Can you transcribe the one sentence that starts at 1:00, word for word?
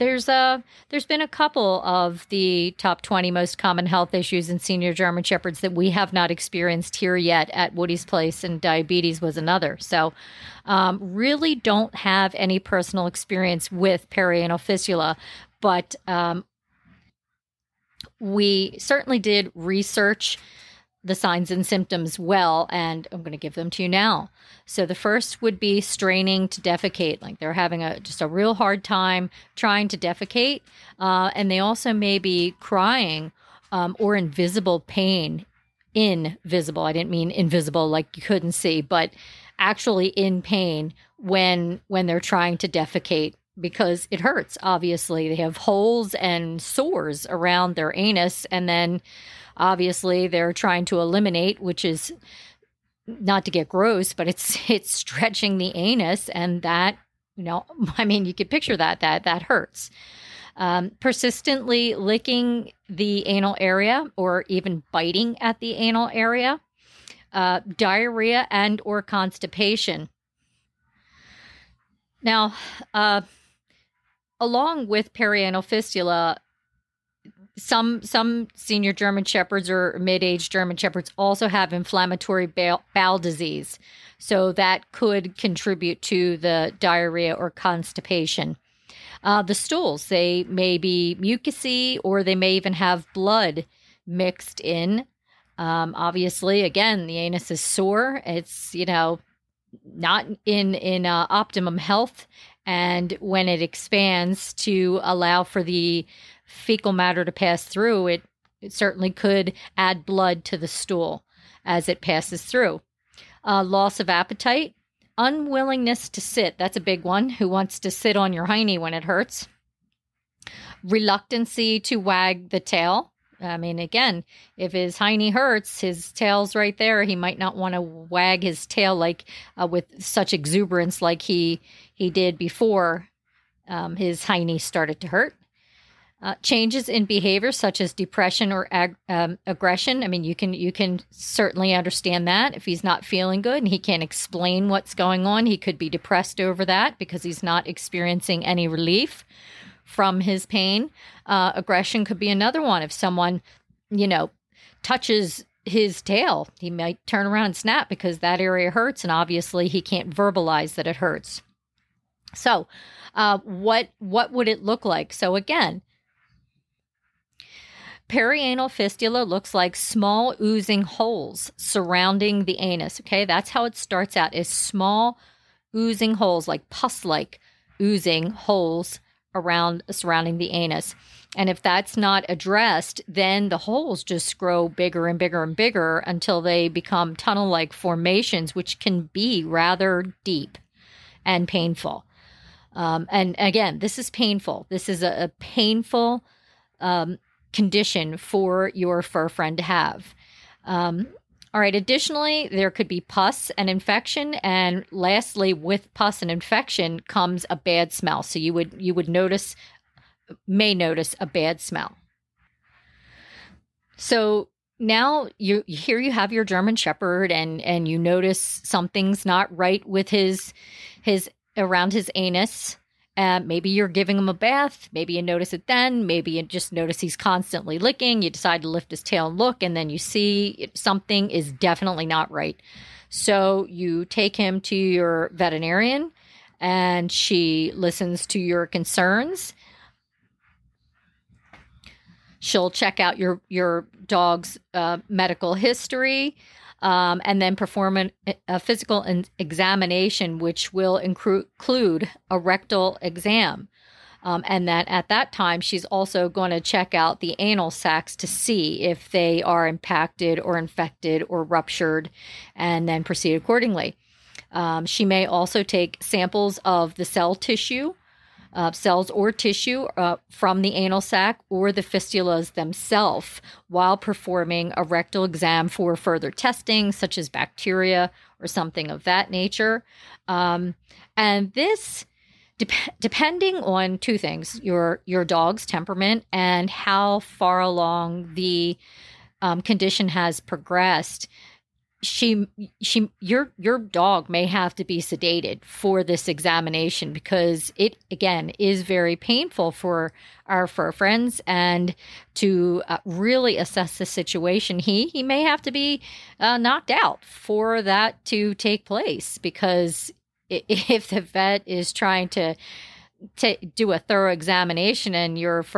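Um, persistently licking the anal area or even biting at the anal area, uh, diarrhea and or constipation.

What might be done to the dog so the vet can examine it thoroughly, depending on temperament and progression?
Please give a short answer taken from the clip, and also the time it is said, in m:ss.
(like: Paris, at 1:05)
sedated, at 4:55.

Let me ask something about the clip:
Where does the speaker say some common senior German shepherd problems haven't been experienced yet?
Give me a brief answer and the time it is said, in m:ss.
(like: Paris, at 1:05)
Woody's place, at 0:07.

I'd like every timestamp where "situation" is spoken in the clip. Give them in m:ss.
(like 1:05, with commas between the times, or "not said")
5:04.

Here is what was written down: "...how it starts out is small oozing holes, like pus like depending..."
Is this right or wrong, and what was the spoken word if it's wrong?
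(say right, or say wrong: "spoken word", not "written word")
wrong: "oozing", not "depending".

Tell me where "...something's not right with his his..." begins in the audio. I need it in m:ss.
3:38.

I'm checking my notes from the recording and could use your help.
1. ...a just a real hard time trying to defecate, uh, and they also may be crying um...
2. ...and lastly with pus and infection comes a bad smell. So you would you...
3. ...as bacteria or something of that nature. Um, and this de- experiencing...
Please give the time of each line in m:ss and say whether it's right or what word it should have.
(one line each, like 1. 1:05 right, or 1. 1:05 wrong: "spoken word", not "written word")
1. 0:27 right
2. 3:24 right
3. 4:37 wrong: "depending", not "experiencing".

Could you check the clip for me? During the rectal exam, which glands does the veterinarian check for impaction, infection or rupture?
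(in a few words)
anal sacs.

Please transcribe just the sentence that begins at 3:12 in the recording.
Um, and again, this is painful.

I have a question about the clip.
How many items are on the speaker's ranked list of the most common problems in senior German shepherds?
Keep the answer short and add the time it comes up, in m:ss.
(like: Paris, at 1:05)
20, at 0:02.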